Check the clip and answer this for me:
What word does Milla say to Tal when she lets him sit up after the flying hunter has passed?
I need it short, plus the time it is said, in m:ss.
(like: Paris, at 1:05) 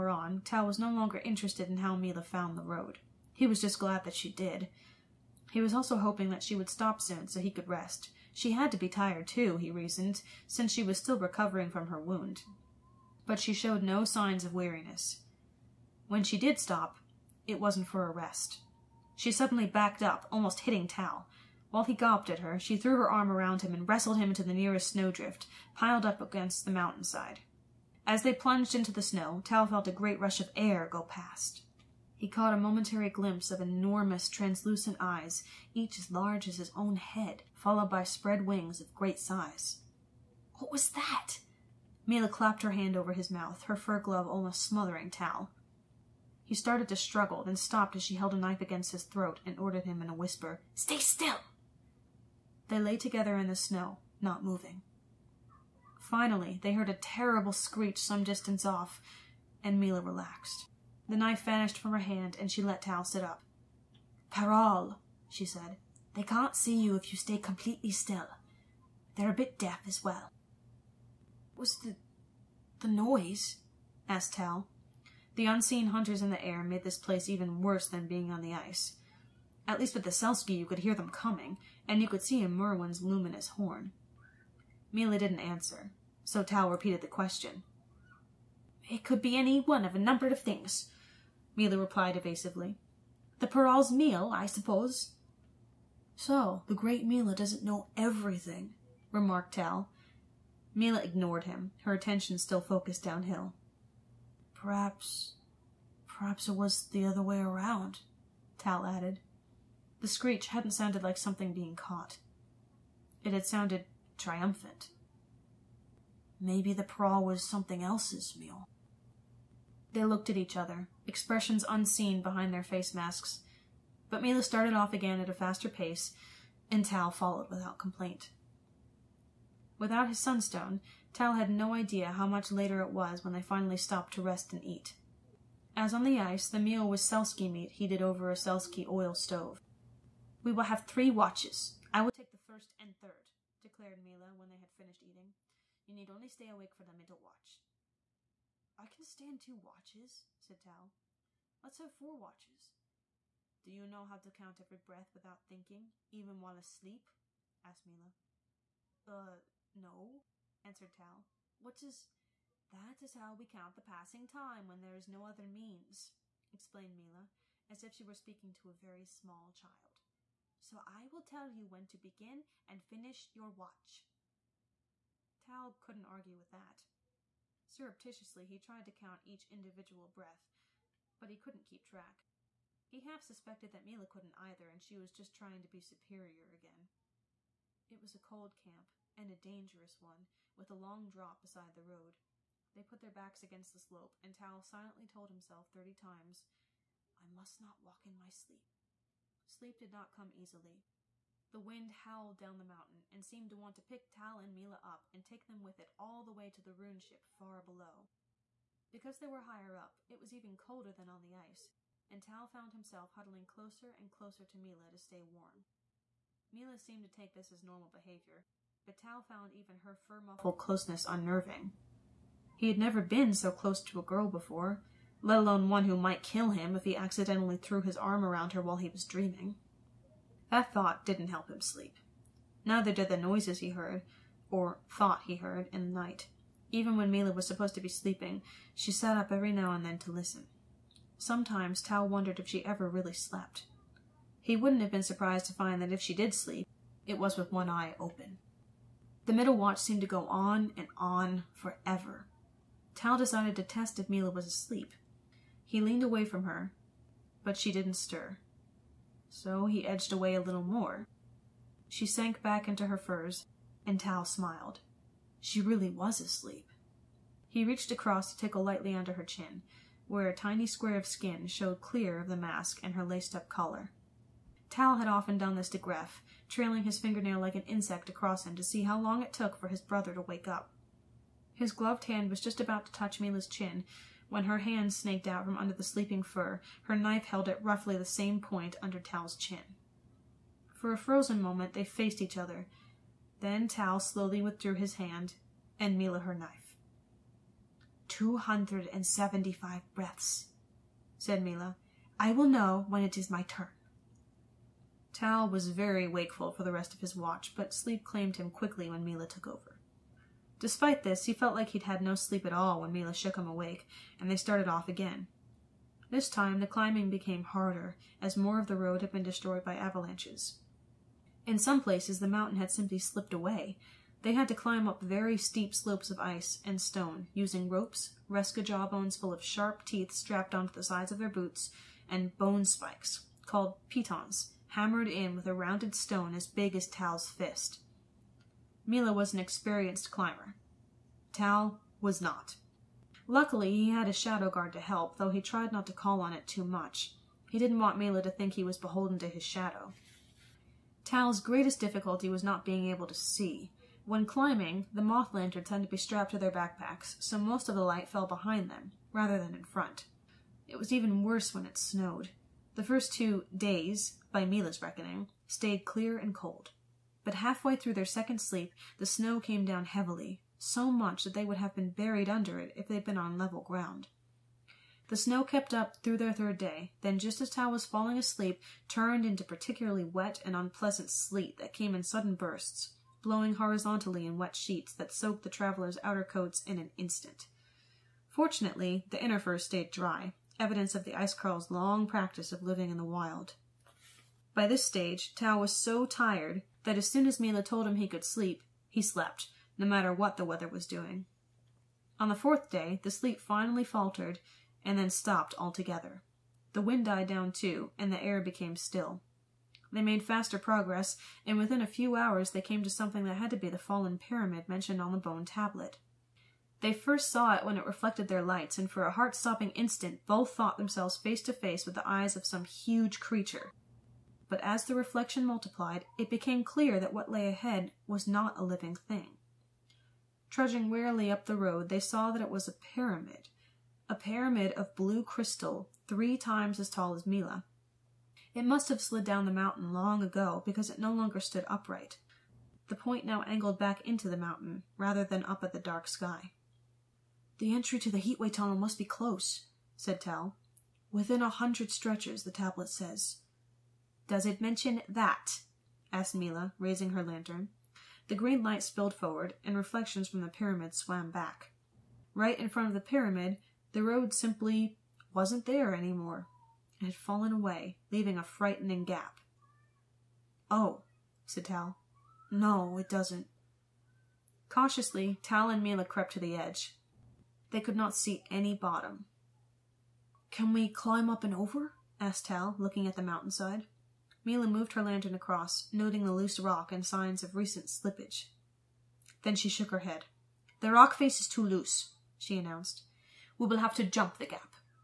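Parole, at 1:04.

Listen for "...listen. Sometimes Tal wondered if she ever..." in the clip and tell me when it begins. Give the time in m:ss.
4:00.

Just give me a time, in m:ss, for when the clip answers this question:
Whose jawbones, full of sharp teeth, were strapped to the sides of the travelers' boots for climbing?
5:28.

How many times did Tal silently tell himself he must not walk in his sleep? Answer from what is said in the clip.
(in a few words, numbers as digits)
30.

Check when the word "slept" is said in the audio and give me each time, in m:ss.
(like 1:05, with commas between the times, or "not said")
4:03, 6:39.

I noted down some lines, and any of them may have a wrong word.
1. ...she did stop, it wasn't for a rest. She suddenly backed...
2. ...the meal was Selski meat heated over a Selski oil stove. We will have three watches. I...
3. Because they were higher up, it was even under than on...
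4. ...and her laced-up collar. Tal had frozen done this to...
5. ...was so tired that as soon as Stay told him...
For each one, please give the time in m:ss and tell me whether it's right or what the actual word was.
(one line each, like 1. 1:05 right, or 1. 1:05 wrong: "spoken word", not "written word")
1. 0:16 right
2. 2:16 right
3. 3:28 wrong: "colder", not "under"
4. 4:32 wrong: "often", not "frozen"
5. 6:35 wrong: "Milla", not "Stay".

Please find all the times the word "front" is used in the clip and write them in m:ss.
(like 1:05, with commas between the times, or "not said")
5:59, 7:42.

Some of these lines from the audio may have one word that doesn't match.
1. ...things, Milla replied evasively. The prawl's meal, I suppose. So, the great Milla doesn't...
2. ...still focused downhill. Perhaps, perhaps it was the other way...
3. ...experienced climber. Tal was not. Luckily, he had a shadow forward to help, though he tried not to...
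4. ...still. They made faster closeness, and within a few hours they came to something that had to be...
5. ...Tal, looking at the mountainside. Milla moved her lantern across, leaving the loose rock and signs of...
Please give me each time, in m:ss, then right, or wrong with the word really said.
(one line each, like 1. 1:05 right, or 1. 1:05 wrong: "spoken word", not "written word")
1. 1:30 right
2. 1:42 right
3. 5:39 wrong: "guard", not "forward"
4. 6:48 wrong: "progress", not "closeness"
5. 8:02 wrong: "noting", not "leaving".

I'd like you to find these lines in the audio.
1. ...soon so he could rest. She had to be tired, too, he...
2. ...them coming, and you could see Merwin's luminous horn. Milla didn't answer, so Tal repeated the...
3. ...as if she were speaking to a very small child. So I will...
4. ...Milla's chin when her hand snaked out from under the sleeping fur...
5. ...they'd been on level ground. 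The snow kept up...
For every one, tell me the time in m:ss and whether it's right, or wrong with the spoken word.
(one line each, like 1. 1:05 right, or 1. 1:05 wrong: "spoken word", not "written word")
1. 0:06 right
2. 1:20 right
3. 2:47 right
4. 4:43 right
5. 6:12 right.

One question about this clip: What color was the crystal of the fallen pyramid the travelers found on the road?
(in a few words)
Blue.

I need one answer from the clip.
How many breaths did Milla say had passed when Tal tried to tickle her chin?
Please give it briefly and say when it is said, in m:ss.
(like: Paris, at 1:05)
275, at 4:58.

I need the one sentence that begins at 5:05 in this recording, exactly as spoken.
Tal was very wakeful for the rest of his watch, but sleep claimed him quickly when Milla took over.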